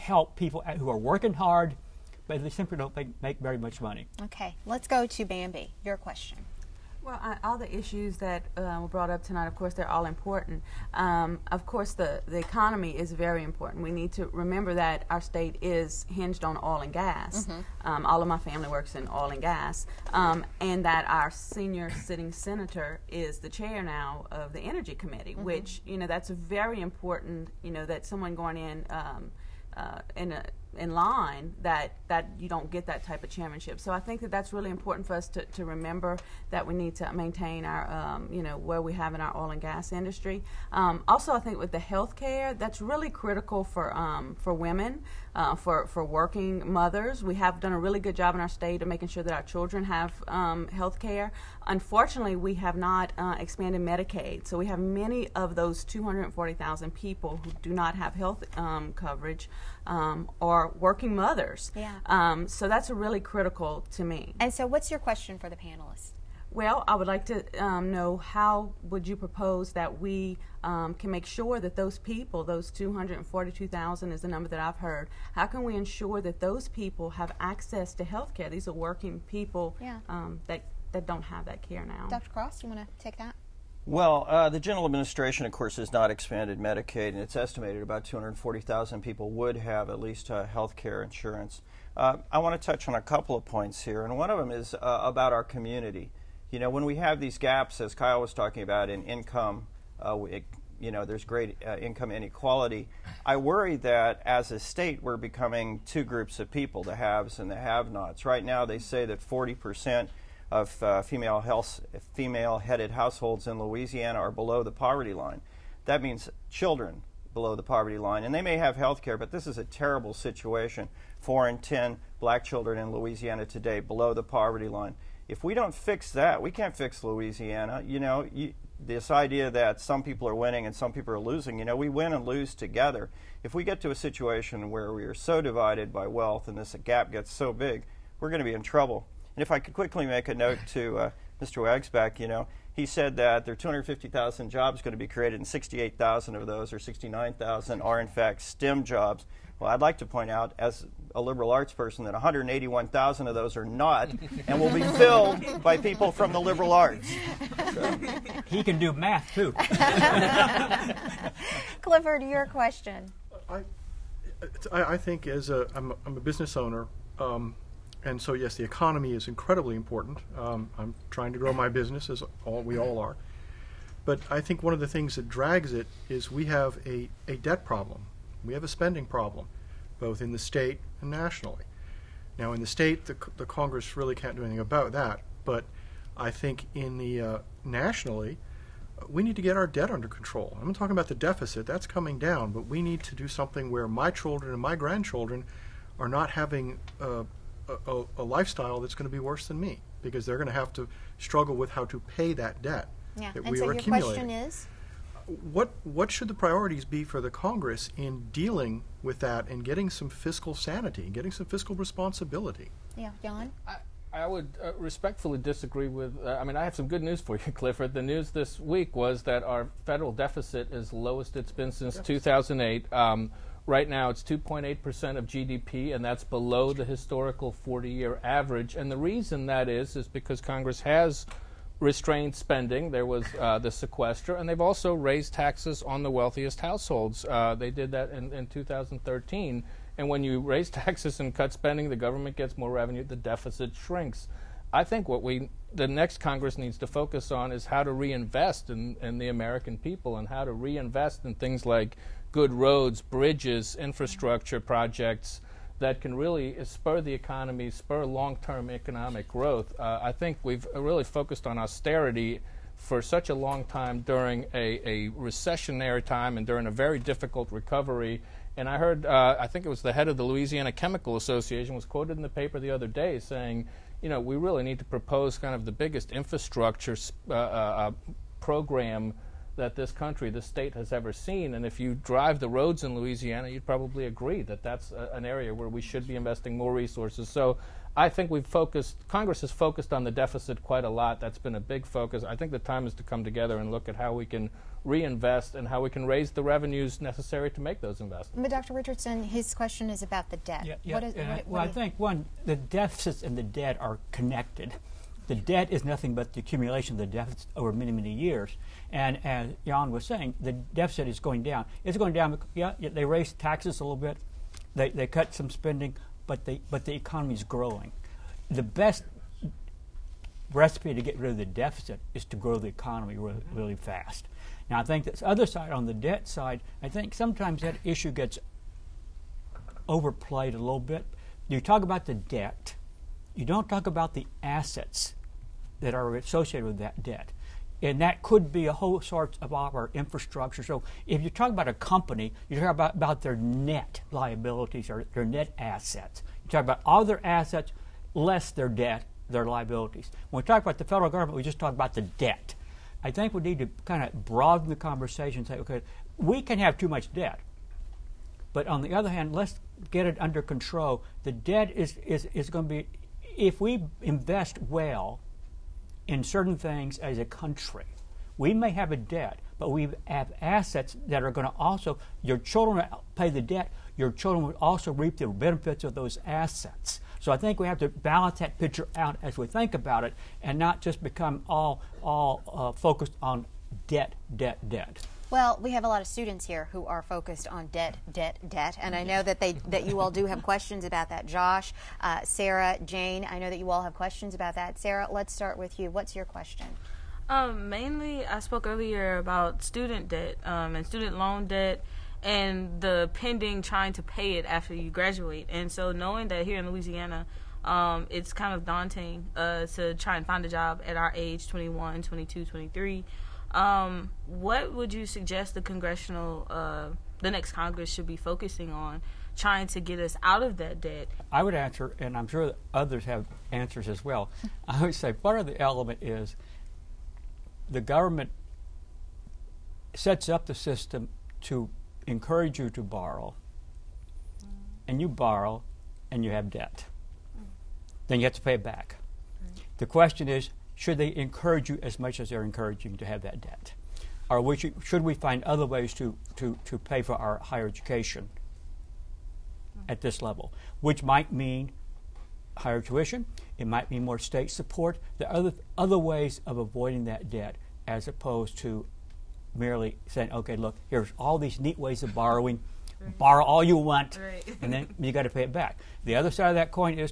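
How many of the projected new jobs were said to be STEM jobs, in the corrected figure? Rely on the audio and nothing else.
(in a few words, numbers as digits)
69,000.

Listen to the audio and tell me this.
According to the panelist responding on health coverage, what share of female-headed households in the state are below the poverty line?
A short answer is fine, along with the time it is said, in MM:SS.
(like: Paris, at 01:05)
40 percent, at 01:49.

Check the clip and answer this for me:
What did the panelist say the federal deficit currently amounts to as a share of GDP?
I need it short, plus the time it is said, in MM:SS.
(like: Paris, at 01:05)
2.8%, at 03:44.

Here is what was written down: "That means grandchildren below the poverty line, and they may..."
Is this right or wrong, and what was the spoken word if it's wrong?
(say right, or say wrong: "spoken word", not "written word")
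wrong: "children", not "grandchildren".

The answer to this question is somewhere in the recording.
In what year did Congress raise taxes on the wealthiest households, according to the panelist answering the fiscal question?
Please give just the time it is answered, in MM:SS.
03:58.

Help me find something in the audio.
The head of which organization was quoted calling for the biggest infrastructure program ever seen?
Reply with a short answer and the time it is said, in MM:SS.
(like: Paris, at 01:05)
Louisiana Chemical Association, at 04:30.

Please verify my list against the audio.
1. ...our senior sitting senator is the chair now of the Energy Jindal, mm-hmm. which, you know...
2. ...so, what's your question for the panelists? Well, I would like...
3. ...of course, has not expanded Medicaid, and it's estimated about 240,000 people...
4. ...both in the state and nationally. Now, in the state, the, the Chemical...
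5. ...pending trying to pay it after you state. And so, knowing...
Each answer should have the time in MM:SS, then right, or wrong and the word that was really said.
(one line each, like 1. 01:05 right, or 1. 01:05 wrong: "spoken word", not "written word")
1. 00:21 wrong: "Committee", not "Jindal"
2. 01:04 right
3. 01:25 right
4. 02:59 wrong: "Congress", not "Chemical"
5. 06:43 wrong: "graduate", not "state".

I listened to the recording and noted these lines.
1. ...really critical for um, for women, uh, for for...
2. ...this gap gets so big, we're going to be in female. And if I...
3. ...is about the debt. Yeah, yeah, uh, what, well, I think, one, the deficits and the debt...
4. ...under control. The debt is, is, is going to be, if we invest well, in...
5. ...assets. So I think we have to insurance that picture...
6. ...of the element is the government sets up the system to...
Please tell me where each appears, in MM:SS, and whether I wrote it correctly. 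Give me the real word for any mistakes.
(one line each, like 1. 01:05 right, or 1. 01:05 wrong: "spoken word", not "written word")
1. 00:42 right
2. 02:16 wrong: "trouble", not "female"
3. 04:59 right
4. 06:00 right
5. 06:16 wrong: "balance", not "insurance"
6. 07:05 right.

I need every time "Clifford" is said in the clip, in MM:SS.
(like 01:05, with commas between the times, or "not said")
02:41, 03:37.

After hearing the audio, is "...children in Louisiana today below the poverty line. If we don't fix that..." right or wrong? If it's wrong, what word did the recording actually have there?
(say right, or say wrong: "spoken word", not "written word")
right.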